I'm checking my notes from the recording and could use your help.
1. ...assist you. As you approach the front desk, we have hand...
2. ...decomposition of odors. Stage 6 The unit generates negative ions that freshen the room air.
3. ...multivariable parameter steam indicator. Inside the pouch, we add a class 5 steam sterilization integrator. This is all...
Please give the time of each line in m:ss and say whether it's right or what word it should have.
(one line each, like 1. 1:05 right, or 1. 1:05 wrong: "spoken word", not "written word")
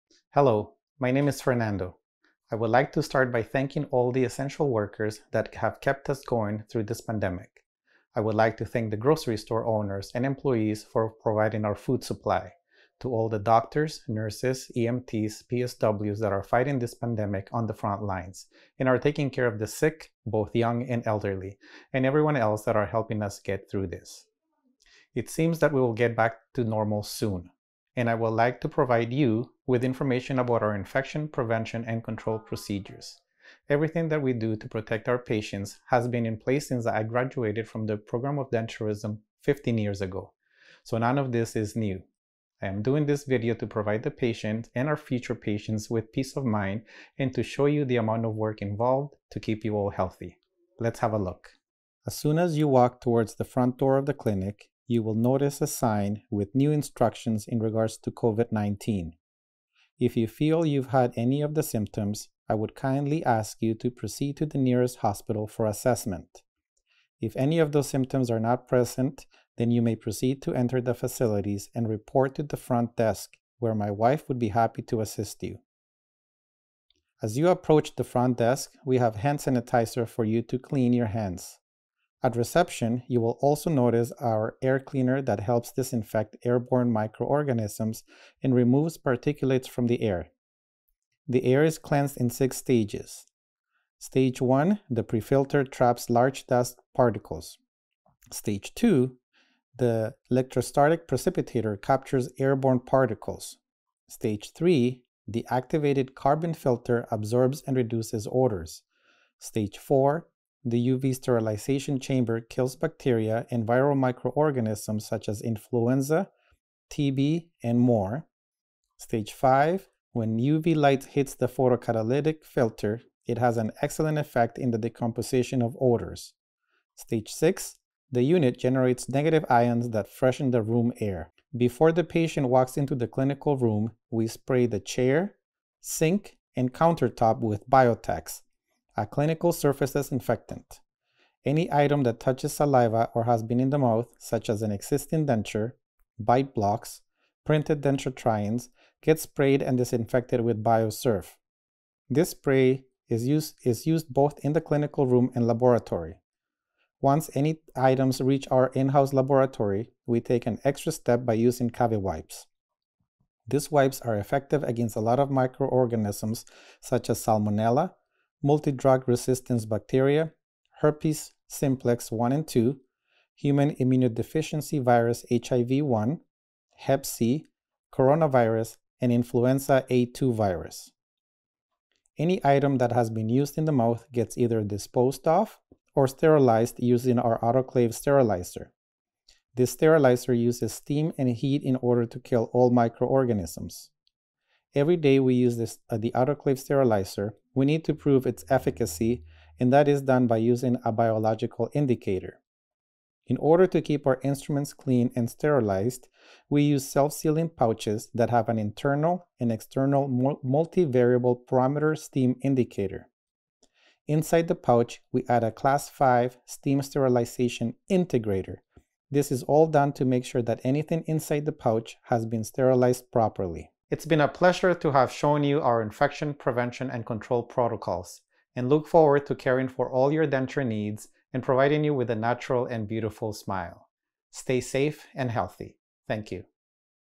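1. 1:14 right
2. 2:04 right
3. 3:30 right.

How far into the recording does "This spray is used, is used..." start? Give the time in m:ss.
2:32.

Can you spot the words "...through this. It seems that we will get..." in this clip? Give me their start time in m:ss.
0:23.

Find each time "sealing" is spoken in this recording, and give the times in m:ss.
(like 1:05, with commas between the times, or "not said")
3:26.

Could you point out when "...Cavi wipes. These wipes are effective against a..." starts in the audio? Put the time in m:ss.
2:41.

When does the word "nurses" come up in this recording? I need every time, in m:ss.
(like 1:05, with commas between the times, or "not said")
0:14.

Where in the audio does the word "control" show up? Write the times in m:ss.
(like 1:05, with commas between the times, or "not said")
0:32, 3:47.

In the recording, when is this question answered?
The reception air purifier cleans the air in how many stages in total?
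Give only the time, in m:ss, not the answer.
1:32.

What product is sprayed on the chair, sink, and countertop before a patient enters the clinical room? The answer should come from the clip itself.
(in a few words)
Biotex.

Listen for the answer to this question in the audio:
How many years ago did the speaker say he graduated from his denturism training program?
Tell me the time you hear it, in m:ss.
0:39.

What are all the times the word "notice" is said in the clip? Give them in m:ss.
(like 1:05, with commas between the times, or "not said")
0:55, 1:23.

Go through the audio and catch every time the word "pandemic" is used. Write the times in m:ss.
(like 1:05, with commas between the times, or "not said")
0:07, 0:16.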